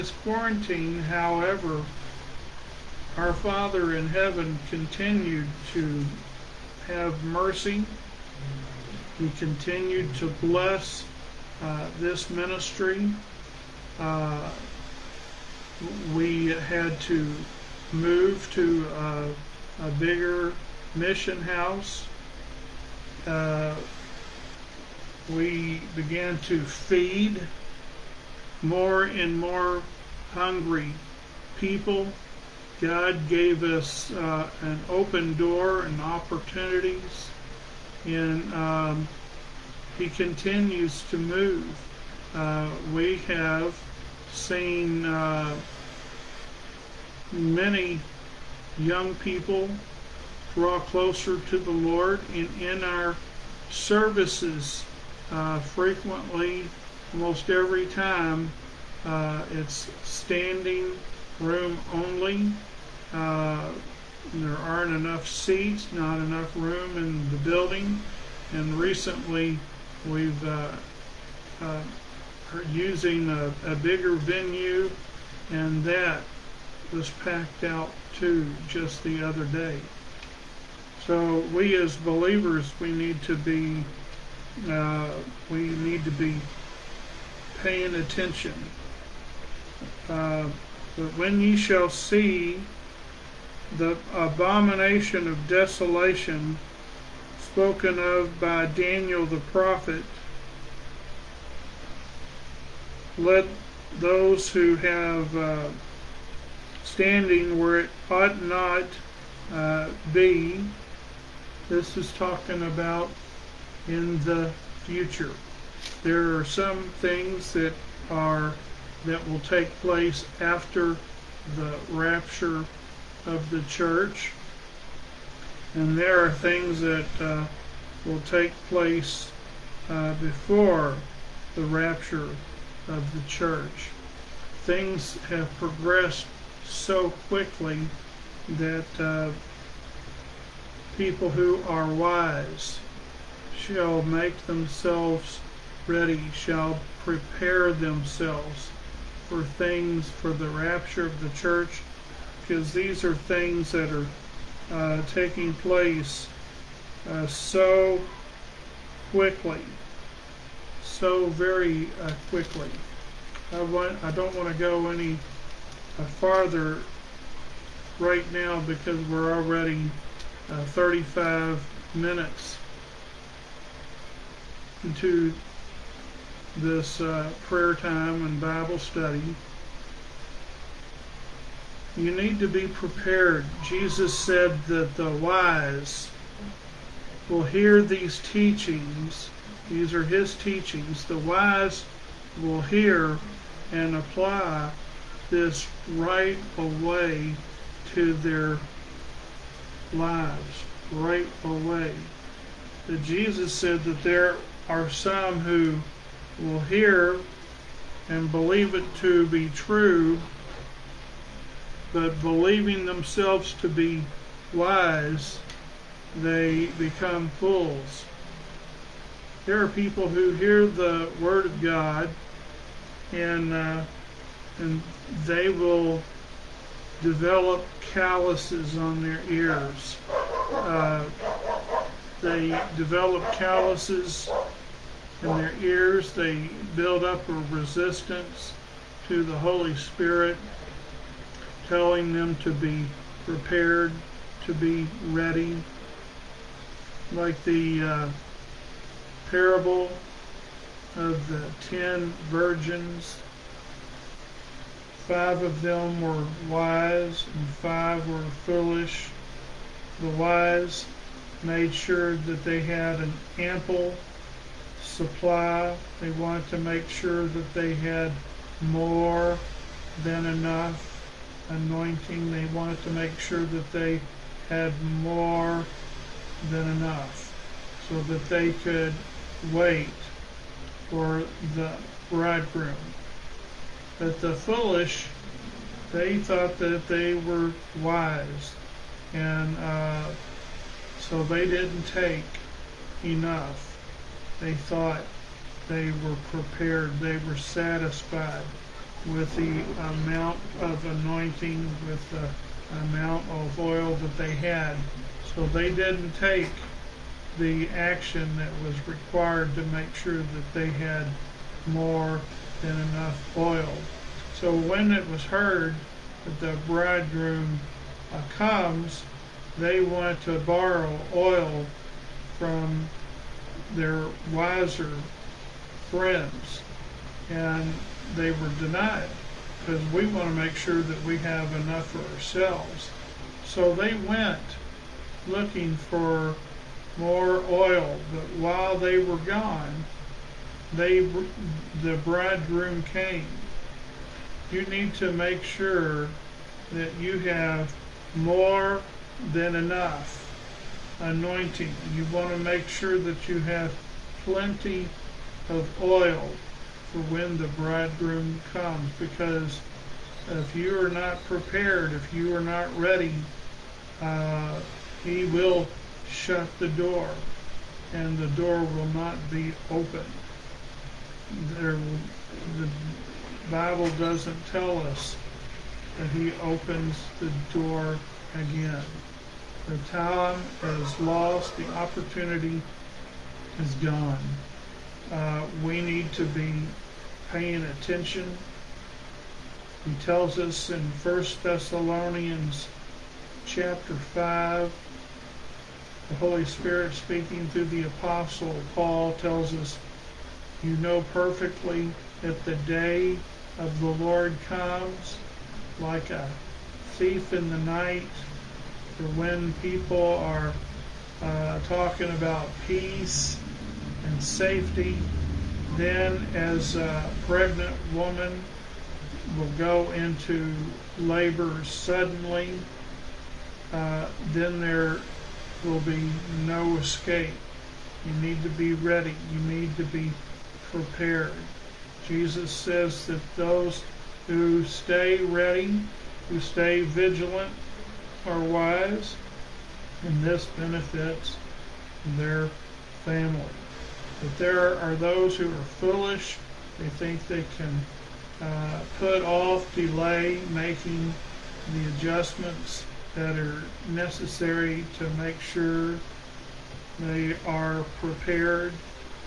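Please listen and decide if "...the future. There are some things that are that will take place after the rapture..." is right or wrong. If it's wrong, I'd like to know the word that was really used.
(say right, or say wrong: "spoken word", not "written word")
right.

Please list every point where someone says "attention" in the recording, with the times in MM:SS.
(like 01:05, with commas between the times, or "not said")
01:27, 06:27.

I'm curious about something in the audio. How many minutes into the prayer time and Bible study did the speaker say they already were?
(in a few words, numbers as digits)
35.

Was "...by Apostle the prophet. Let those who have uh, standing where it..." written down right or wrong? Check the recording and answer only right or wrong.
wrong.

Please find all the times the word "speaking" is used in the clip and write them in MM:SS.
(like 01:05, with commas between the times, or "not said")
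06:36.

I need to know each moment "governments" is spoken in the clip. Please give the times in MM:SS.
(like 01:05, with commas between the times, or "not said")
not said.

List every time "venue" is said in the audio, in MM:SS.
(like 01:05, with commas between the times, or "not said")
01:14.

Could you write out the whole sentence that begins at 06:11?
There, the Bible doesn't tell us that he opens the door again.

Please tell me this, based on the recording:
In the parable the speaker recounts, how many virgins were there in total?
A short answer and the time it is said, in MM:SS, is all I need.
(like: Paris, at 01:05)
10, at 04:11.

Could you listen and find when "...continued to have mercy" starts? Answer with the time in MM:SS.
00:04.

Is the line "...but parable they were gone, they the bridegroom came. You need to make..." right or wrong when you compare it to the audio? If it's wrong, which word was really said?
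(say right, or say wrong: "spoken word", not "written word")
wrong: "while", not "parable".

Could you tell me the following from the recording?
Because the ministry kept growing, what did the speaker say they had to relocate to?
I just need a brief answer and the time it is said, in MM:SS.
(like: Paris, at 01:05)
A bigger mission house, at 00:19.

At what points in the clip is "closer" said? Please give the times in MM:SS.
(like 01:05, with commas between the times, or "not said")
00:50.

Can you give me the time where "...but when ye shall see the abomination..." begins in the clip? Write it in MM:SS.
01:30.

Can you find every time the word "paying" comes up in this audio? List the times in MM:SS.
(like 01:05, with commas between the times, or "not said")
01:27, 06:27.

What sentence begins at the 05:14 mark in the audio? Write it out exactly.
So when it was heard that the bridegroom uh, comes, they want to borrow oil from their wiser friends.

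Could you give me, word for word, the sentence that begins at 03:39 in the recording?
There are people who hear the word of God, and uh, and they will develop calluses on their ears.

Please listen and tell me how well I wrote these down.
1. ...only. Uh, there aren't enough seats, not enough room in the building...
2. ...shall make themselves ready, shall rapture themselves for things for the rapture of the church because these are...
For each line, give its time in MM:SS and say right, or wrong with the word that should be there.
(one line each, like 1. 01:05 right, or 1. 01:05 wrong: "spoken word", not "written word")
1. 01:01 right
2. 02:23 wrong: "prepare", not "rapture".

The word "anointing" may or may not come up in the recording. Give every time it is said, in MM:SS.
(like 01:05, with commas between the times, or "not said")
04:31, 05:00, 05:51.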